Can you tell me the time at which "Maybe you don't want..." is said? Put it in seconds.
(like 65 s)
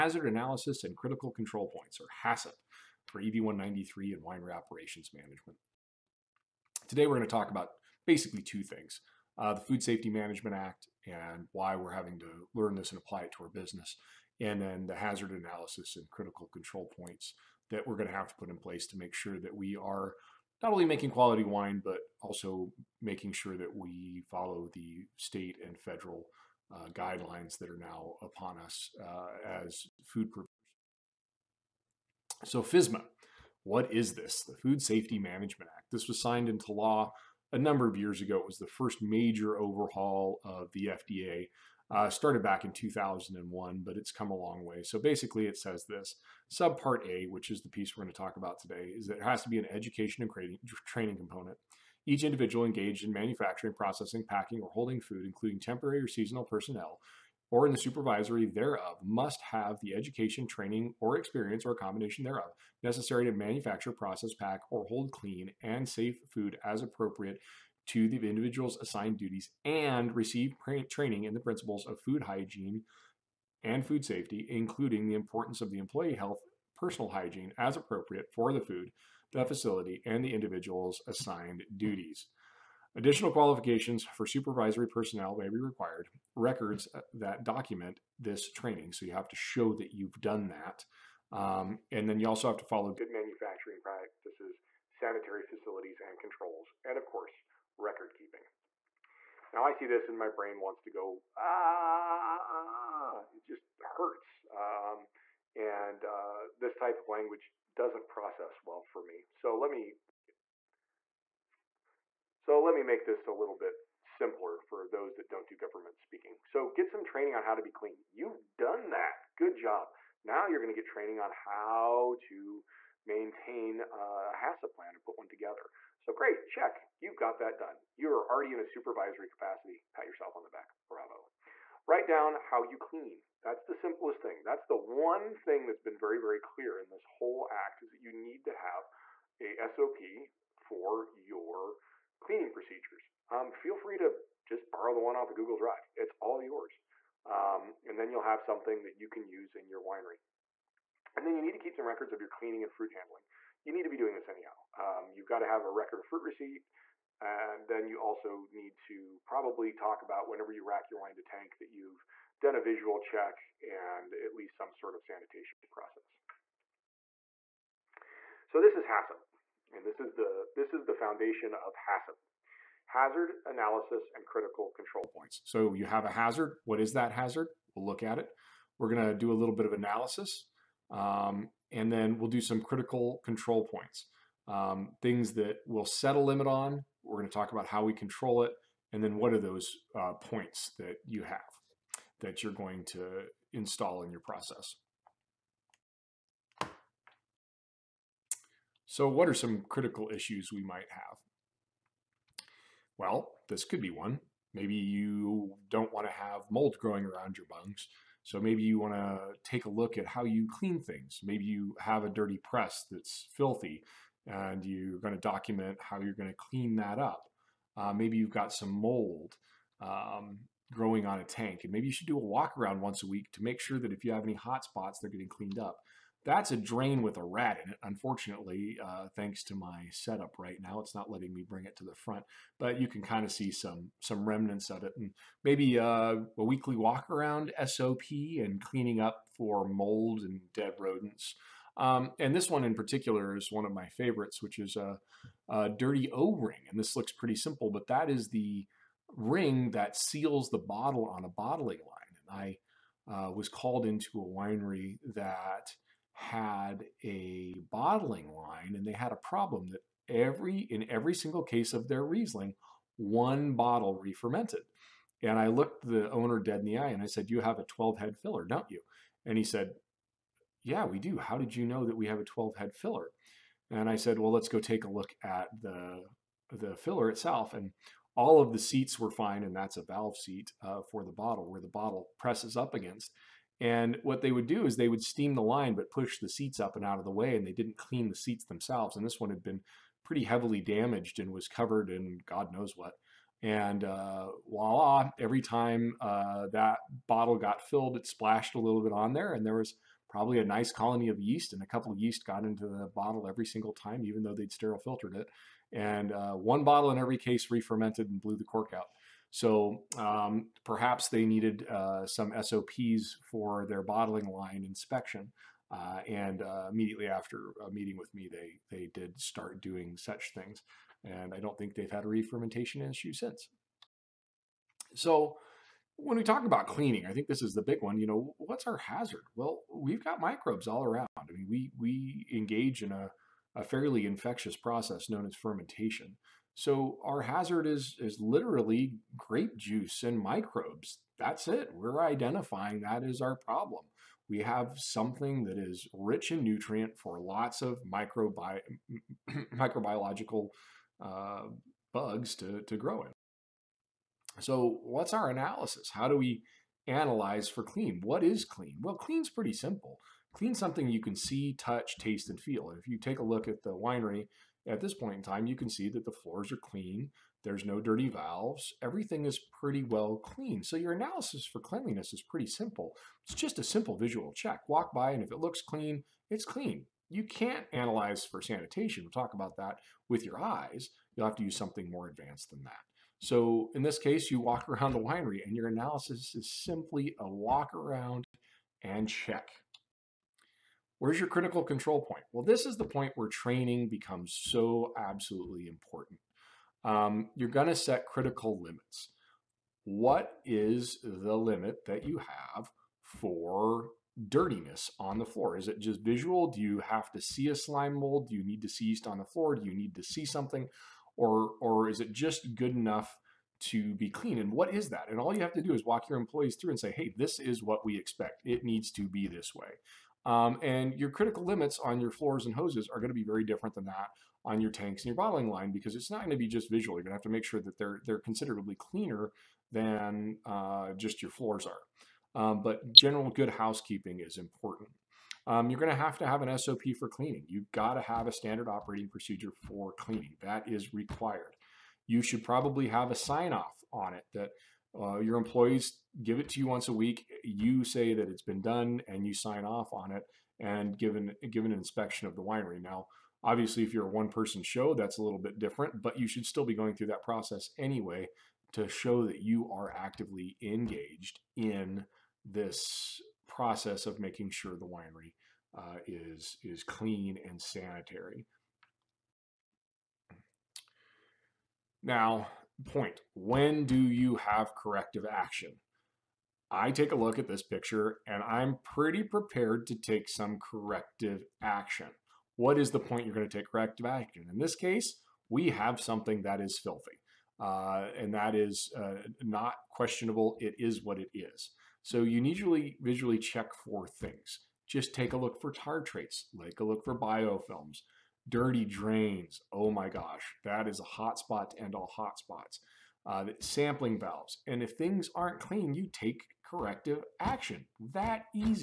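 204 s.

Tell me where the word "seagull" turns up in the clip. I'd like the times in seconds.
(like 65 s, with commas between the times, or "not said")
not said.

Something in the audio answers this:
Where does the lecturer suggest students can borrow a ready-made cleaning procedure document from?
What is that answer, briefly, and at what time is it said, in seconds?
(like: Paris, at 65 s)
The Google Drive, at 145 s.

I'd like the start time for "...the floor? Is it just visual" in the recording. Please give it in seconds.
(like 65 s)
405 s.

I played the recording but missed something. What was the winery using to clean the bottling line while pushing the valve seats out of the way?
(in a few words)
Steam.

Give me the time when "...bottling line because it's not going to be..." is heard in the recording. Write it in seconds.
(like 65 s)
425 s.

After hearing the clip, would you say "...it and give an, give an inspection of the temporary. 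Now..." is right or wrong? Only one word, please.
wrong.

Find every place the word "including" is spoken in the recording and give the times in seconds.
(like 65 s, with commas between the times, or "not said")
55 s, 74 s.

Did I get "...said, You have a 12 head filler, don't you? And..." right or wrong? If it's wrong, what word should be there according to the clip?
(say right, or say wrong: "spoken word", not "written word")
right.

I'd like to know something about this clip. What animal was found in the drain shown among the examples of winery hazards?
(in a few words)
A rat.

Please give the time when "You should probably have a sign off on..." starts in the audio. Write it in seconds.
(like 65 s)
442 s.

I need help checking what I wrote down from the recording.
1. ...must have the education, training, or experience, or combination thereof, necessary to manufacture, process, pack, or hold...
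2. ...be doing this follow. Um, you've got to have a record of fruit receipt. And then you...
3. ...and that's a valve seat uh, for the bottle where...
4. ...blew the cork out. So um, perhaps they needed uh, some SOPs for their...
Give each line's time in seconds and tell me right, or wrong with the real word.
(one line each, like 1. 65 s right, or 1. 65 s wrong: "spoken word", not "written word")
1. 59 s right
2. 153 s wrong: "anyhow", not "follow"
3. 279 s right
4. 308 s right.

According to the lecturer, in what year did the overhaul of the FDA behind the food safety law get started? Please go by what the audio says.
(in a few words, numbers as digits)
2001.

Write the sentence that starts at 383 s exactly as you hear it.
So in this case, you walk around the winery and your analysis is simply a walk around and check.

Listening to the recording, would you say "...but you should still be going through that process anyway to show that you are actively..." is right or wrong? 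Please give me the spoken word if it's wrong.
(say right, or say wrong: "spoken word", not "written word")
right.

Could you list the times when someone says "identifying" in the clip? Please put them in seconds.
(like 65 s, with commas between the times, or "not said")
342 s.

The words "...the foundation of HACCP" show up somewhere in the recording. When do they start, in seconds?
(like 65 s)
170 s.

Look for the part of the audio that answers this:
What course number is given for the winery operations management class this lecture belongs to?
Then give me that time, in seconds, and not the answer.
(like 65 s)
3 s.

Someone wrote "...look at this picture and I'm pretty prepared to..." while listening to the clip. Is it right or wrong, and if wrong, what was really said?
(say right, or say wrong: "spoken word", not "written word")
right.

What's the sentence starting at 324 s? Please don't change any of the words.
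So when we talk about cleaning, I think this is the big one.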